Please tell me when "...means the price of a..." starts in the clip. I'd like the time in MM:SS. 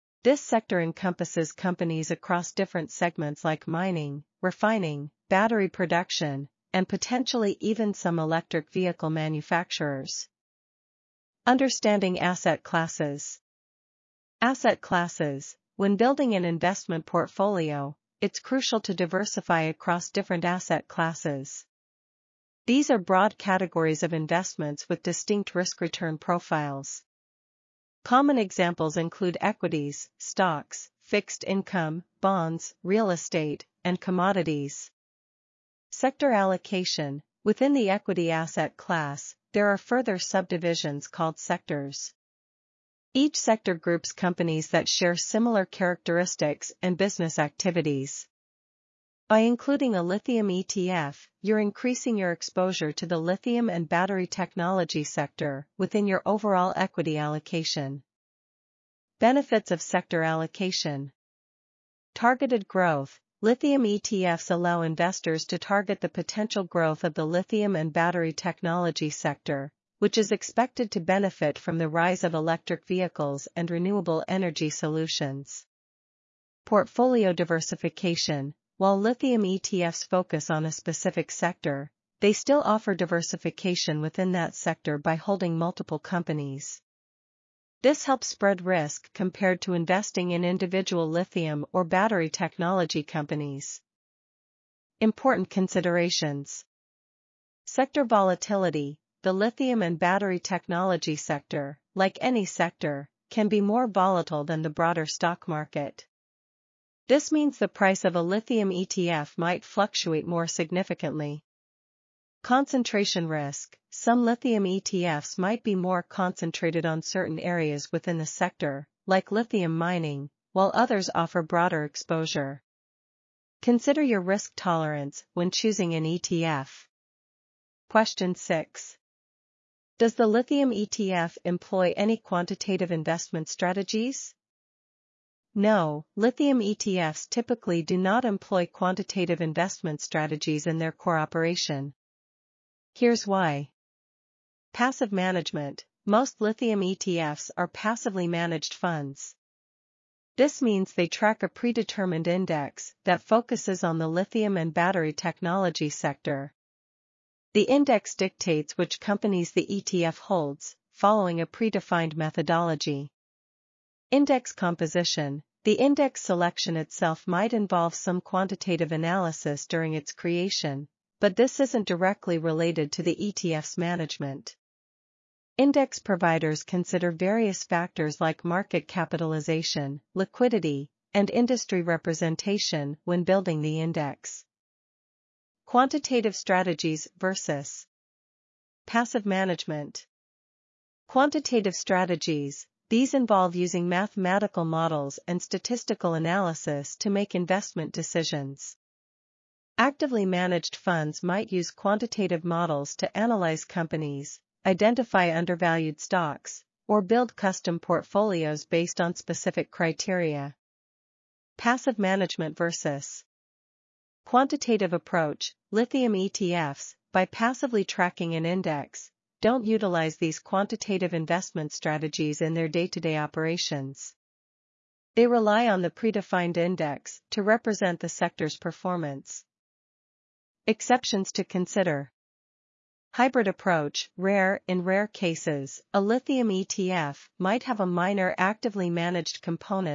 01:47.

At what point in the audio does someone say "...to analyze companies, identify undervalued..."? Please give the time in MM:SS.
03:22.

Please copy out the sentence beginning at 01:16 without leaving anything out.
Portfolio diversification while lithium ETFs focus on a specific sector, they still offer diversification within that sector by holding multiple companies.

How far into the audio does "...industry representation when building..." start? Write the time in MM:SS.
03:01.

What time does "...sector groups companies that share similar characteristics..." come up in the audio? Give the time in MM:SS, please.
00:43.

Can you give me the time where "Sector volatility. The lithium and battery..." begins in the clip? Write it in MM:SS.
01:37.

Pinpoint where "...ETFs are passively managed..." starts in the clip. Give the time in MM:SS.
02:26.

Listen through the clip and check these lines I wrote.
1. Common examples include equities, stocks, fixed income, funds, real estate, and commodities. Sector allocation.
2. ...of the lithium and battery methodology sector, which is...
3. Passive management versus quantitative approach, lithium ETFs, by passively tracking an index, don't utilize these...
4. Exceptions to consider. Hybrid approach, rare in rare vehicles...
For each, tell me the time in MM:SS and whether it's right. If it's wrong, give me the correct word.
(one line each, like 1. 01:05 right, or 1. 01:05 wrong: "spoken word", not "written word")
1. 00:28 wrong: "bonds", not "funds"
2. 01:07 wrong: "technology", not "methodology"
3. 03:31 right
4. 03:50 wrong: "cases", not "vehicles".